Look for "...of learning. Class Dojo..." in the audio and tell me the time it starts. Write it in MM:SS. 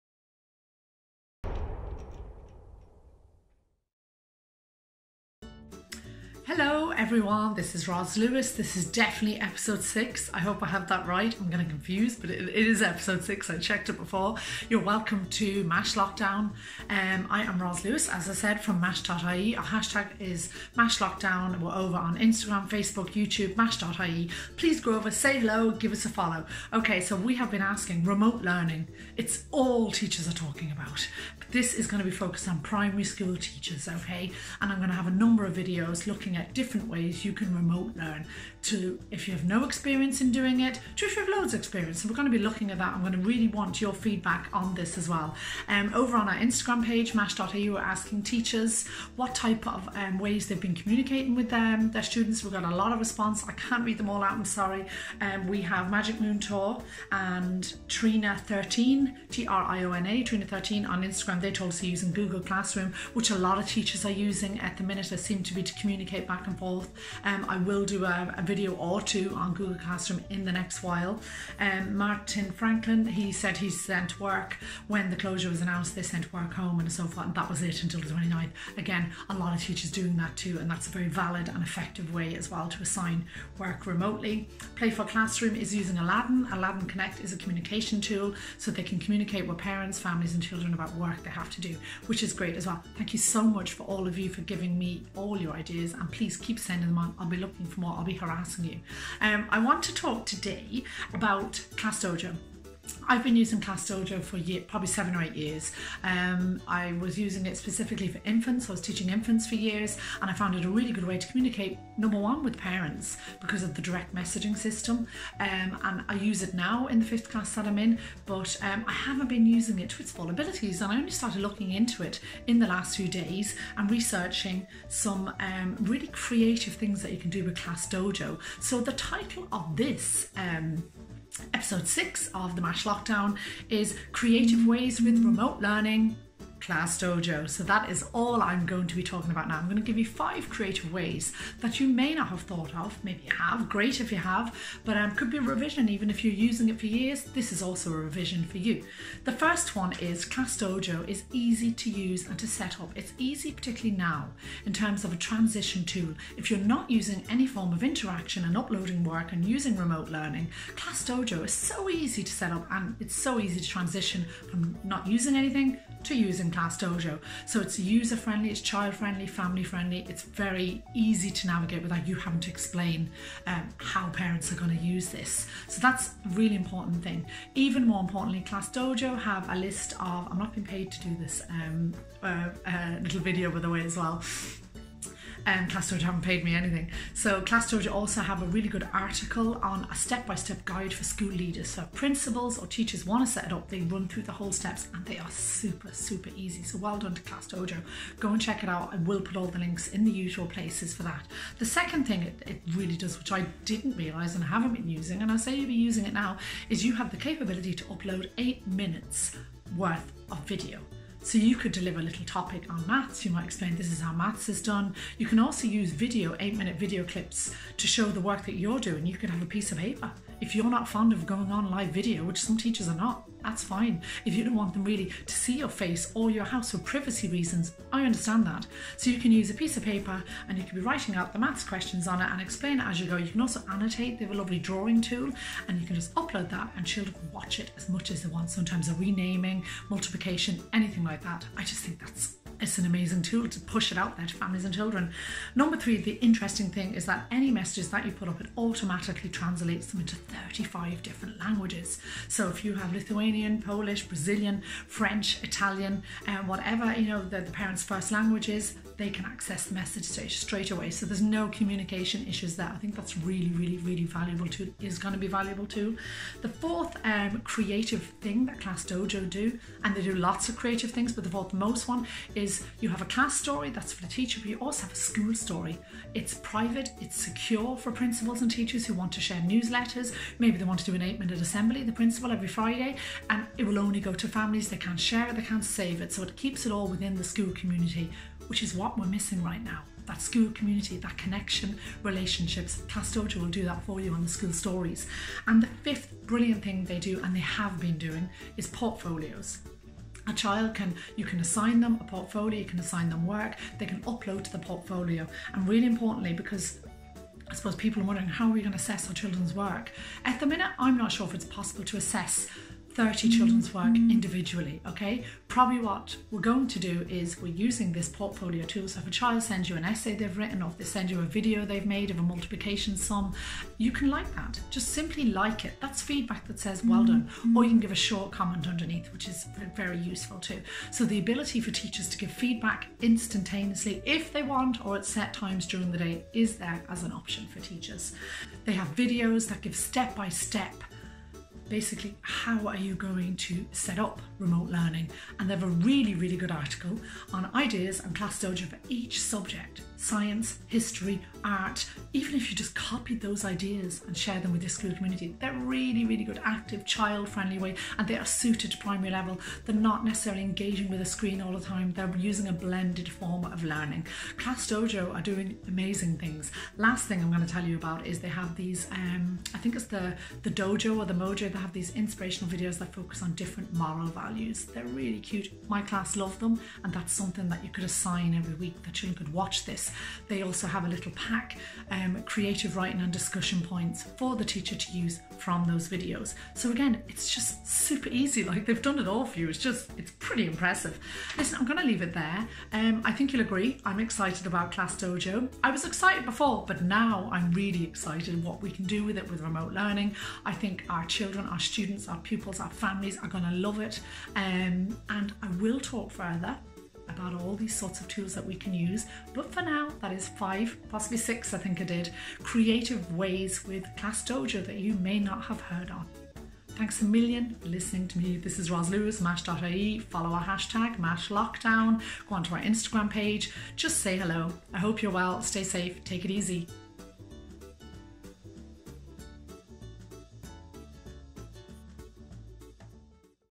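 06:03.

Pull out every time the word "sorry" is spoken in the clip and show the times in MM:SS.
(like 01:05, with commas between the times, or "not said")
00:54.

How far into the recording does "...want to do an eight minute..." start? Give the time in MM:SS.
04:40.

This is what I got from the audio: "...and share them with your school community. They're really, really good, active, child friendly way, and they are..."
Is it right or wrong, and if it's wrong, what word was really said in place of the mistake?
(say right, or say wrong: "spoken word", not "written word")
right.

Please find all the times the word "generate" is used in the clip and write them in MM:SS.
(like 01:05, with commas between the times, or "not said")
not said.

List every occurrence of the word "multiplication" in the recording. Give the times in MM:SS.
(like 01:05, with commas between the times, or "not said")
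03:59, 05:22.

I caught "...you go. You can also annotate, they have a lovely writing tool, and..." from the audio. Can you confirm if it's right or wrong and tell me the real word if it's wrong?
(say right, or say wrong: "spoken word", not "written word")
wrong: "drawing", not "writing".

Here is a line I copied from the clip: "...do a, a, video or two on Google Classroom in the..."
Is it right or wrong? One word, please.
right.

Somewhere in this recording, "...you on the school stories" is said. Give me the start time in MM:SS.
04:53.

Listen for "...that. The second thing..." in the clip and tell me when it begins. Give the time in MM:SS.
03:21.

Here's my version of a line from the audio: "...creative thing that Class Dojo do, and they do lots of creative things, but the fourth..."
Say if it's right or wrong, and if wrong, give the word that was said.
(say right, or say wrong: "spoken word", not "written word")
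right.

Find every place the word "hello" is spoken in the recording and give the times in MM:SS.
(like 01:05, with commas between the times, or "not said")
00:06, 00:25, 07:04.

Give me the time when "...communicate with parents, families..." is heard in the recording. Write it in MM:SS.
01:28.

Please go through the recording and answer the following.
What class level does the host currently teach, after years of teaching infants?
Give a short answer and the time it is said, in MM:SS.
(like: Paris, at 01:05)
Fifth class, at 01:57.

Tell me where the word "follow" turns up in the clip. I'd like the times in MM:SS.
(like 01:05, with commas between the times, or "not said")
00:26, 06:59.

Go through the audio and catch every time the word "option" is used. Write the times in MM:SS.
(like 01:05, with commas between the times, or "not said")
05:37.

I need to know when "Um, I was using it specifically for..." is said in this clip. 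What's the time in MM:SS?
01:46.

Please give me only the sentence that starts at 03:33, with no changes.
You might explain this is how maths is done.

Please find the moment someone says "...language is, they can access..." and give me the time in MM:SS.
04:18.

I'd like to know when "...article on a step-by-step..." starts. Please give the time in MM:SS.
03:08.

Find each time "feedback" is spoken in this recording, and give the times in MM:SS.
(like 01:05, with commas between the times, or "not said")
00:43, 05:26, 05:32.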